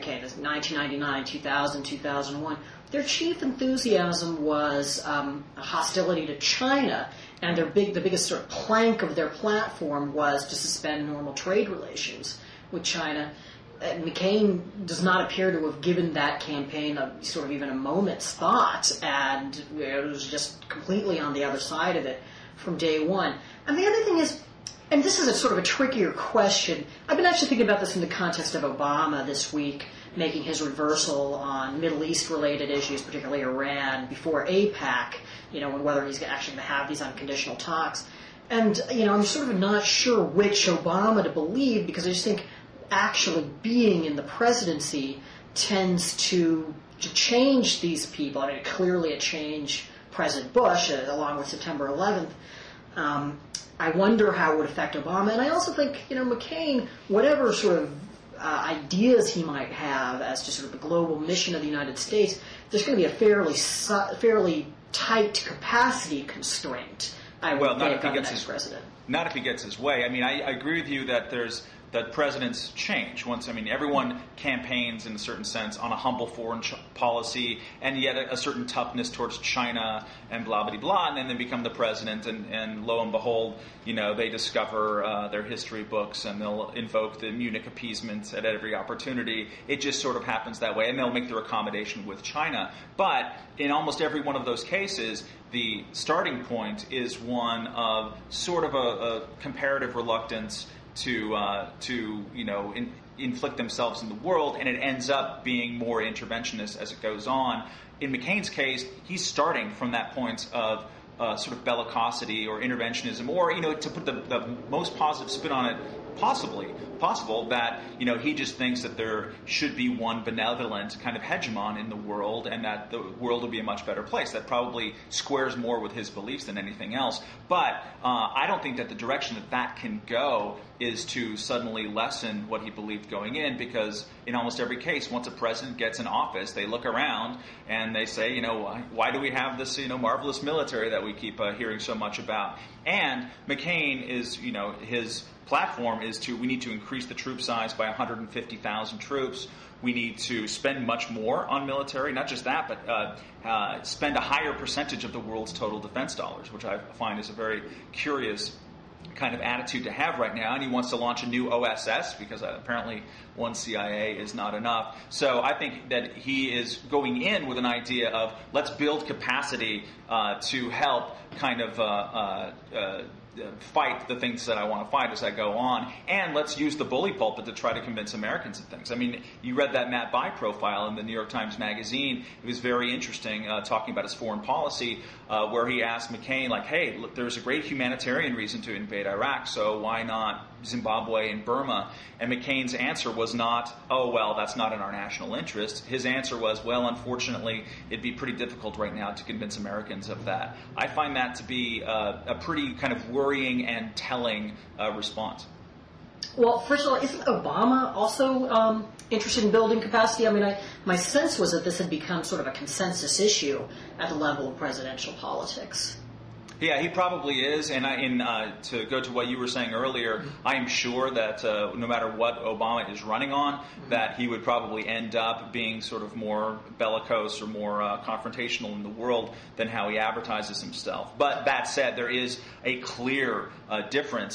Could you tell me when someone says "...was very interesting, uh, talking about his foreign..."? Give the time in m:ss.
3:02.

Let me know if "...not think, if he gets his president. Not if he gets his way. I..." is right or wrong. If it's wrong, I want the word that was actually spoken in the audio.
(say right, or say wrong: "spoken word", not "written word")
right.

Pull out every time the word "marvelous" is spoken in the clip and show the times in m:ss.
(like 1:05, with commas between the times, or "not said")
2:19.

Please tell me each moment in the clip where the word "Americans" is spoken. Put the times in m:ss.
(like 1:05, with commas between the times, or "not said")
2:58, 3:19.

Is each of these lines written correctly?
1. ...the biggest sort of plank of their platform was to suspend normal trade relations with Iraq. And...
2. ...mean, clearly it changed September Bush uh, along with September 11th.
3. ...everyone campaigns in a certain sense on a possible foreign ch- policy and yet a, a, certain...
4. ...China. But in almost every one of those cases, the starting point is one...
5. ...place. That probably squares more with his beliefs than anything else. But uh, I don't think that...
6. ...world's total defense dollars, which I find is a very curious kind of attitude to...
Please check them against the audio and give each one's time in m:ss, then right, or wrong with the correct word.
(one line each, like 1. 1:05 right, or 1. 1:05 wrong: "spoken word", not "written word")
1. 0:07 wrong: "China", not "Iraq"
2. 0:48 wrong: "President", not "September"
3. 1:13 wrong: "humble", not "possible"
4. 1:32 right
5. 2:04 right
6. 2:35 right.